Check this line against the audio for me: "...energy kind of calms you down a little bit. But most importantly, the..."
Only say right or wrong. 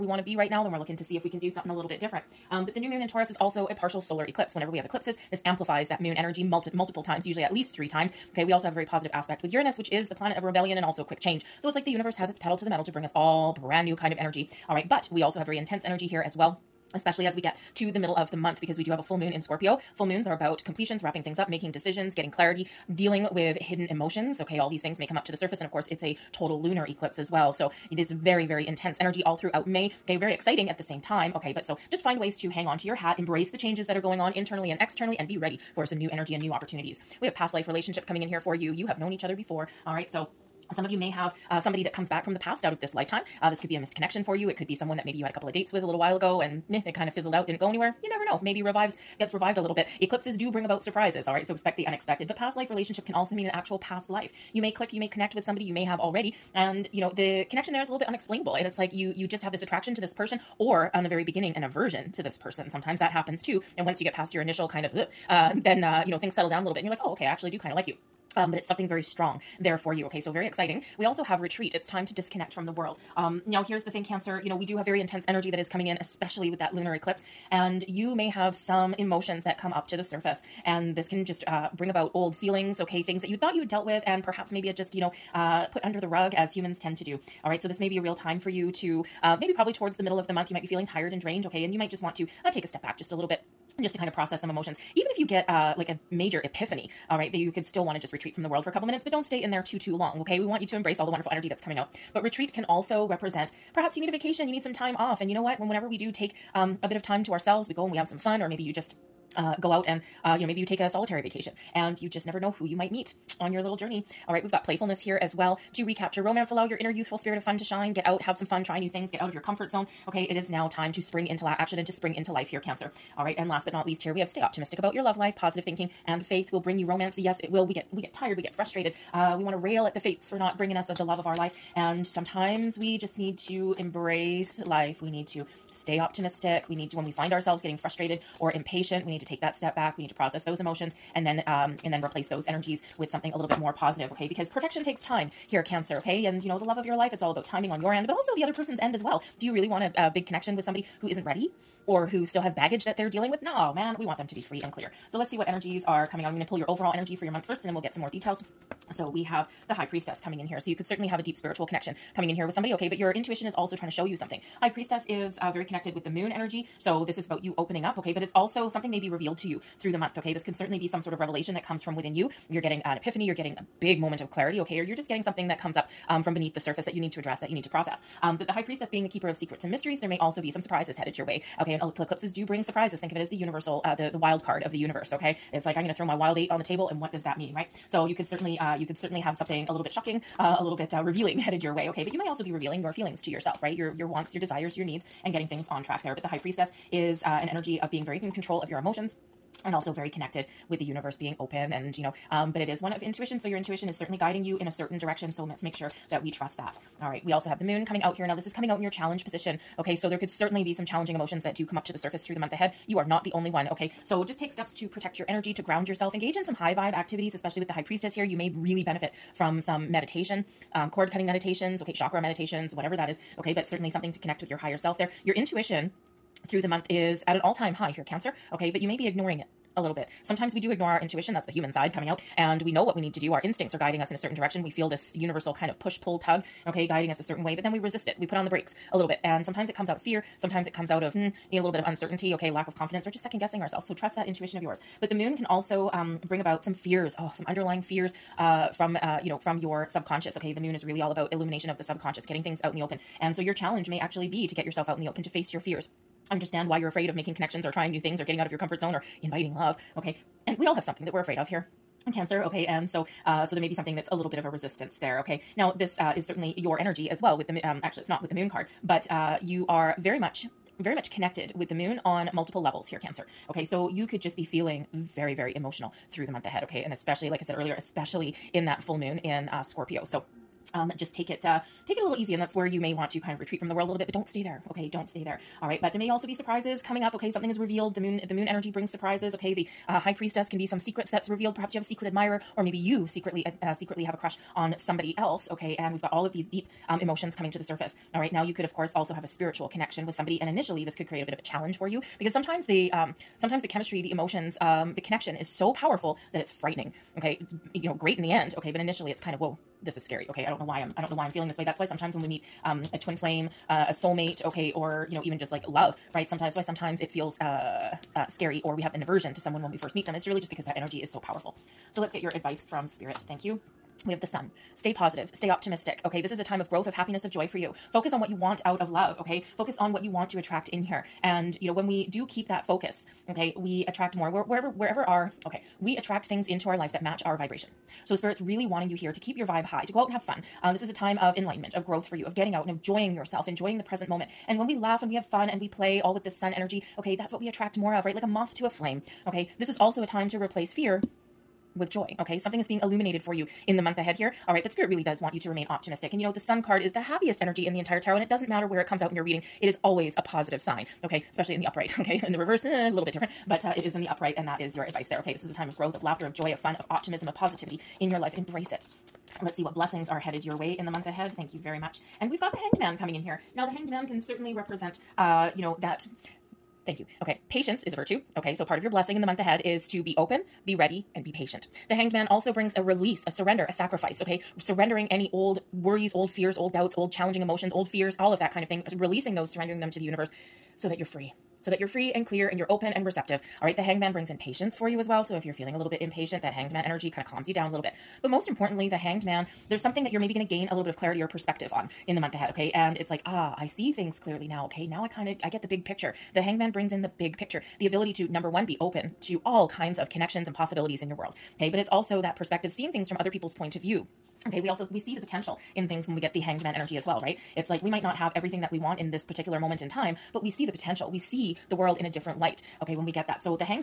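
right.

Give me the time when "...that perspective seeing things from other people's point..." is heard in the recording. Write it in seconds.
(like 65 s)
412 s.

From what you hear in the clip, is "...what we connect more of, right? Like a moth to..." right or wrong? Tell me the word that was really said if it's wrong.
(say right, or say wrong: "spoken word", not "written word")
wrong: "attract", not "connect".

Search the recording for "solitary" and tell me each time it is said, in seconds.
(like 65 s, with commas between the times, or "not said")
110 s.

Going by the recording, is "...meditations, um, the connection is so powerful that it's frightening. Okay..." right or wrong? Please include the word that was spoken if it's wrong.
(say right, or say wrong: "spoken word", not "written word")
wrong: "emotions", not "meditations".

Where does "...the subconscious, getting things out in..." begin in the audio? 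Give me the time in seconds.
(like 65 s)
251 s.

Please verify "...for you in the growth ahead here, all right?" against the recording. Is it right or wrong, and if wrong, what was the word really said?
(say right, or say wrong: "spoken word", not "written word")
wrong: "month", not "growth".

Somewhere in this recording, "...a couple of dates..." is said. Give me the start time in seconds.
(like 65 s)
45 s.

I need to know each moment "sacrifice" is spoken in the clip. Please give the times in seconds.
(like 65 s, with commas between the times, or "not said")
383 s.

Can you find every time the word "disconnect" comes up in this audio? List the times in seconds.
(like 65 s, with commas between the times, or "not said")
72 s.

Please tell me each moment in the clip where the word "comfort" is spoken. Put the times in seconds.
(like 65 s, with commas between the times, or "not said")
119 s, 258 s.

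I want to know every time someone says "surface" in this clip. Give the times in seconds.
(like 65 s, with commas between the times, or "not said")
25 s, 80 s, 176 s, 211 s, 297 s.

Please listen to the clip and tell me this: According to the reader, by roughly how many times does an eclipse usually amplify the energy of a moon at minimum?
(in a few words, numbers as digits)
3.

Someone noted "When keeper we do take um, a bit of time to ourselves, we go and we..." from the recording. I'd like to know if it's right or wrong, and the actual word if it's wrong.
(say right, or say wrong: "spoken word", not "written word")
wrong: "whenever", not "keeper".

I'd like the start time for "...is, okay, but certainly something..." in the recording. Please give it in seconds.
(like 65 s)
223 s.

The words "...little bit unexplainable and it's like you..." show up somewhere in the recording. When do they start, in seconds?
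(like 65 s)
57 s.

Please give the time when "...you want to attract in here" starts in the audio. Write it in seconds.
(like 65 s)
330 s.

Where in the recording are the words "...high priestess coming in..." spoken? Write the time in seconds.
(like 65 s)
159 s.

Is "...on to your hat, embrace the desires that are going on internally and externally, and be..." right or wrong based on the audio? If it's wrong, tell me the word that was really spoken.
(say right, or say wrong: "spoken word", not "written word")
wrong: "changes", not "desires".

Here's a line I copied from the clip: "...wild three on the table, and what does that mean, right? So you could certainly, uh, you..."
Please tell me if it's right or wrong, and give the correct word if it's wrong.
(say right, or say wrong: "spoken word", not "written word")
wrong: "eight", not "three".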